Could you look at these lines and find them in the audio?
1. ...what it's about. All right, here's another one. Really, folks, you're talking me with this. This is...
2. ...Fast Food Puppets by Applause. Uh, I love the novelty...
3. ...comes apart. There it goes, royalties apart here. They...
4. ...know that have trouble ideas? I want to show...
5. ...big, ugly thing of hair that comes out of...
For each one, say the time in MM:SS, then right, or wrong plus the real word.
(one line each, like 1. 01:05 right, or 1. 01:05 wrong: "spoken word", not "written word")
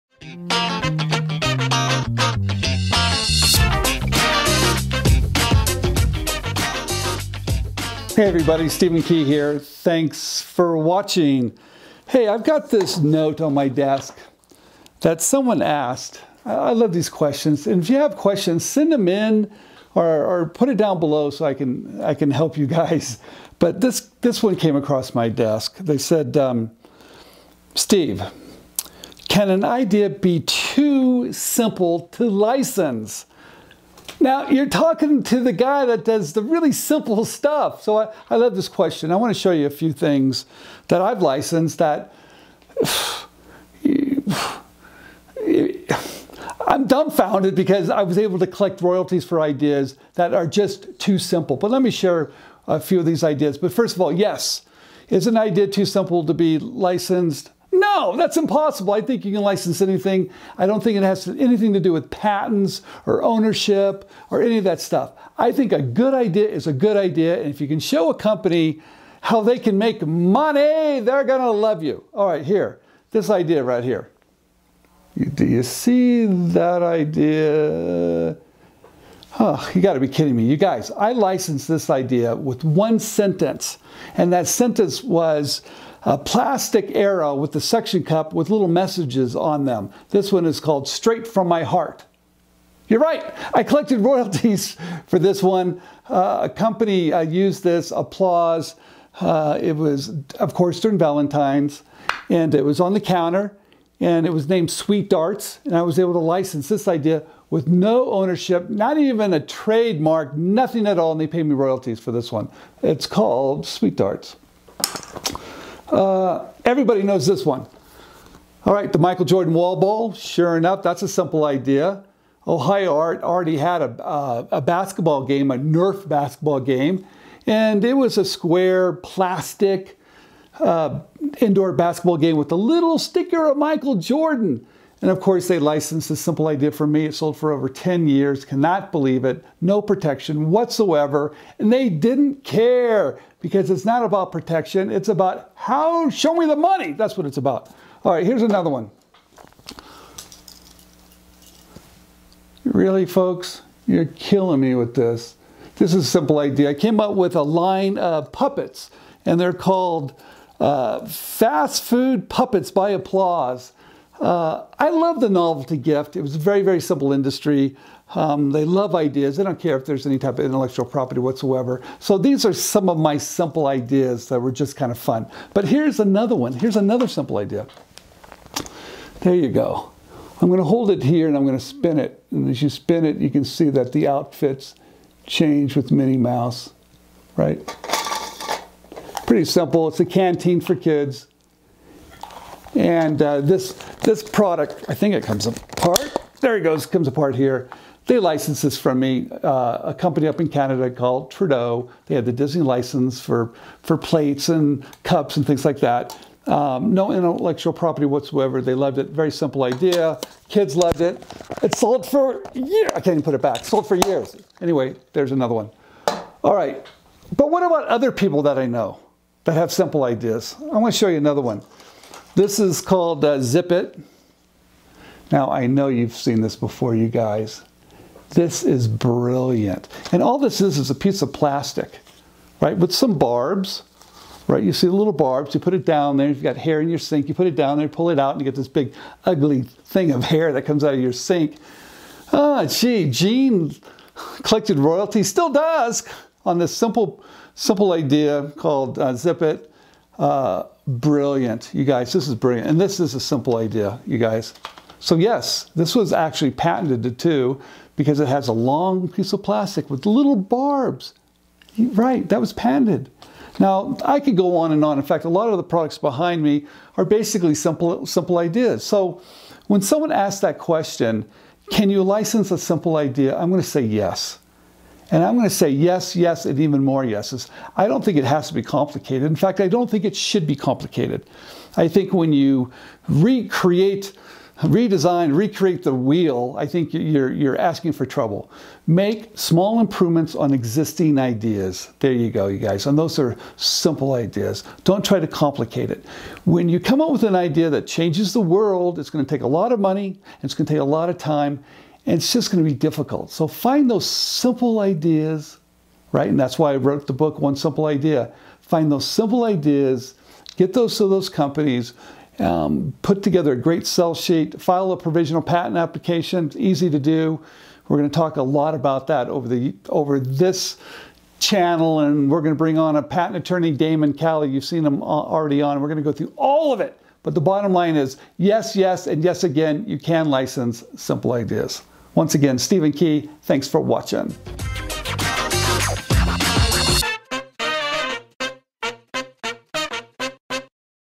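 1. 02:27 wrong: "killing", not "talking"
2. 02:41 right
3. 03:15 wrong: "comes", not "royalties"
4. 03:38 wrong: "simple", not "trouble"
5. 03:58 right.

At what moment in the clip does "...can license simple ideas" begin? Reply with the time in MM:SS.
05:29.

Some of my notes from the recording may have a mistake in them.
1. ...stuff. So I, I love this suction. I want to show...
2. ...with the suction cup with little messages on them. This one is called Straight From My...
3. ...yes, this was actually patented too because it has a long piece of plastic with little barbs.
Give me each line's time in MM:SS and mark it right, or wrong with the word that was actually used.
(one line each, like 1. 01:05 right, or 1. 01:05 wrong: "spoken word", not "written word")
1. 00:37 wrong: "question", not "suction"
2. 01:27 right
3. 04:15 right.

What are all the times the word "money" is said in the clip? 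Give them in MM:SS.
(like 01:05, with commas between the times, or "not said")
01:10, 02:26, 04:59.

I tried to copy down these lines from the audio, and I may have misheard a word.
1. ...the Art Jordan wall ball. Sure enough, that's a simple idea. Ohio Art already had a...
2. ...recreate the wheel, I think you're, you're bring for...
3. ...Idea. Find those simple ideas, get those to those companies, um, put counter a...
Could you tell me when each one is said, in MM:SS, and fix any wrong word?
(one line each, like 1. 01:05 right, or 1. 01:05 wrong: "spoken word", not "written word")
1. 01:58 wrong: "Michael", not "Art"
2. 04:45 wrong: "asking", not "bring"
3. 05:07 wrong: "together", not "counter".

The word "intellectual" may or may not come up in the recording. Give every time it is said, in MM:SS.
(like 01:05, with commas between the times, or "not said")
02:50, 03:27.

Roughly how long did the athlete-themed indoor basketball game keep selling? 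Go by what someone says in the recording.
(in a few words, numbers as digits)
over 10 years.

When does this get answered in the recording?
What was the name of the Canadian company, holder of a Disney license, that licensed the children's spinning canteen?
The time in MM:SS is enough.
03:21.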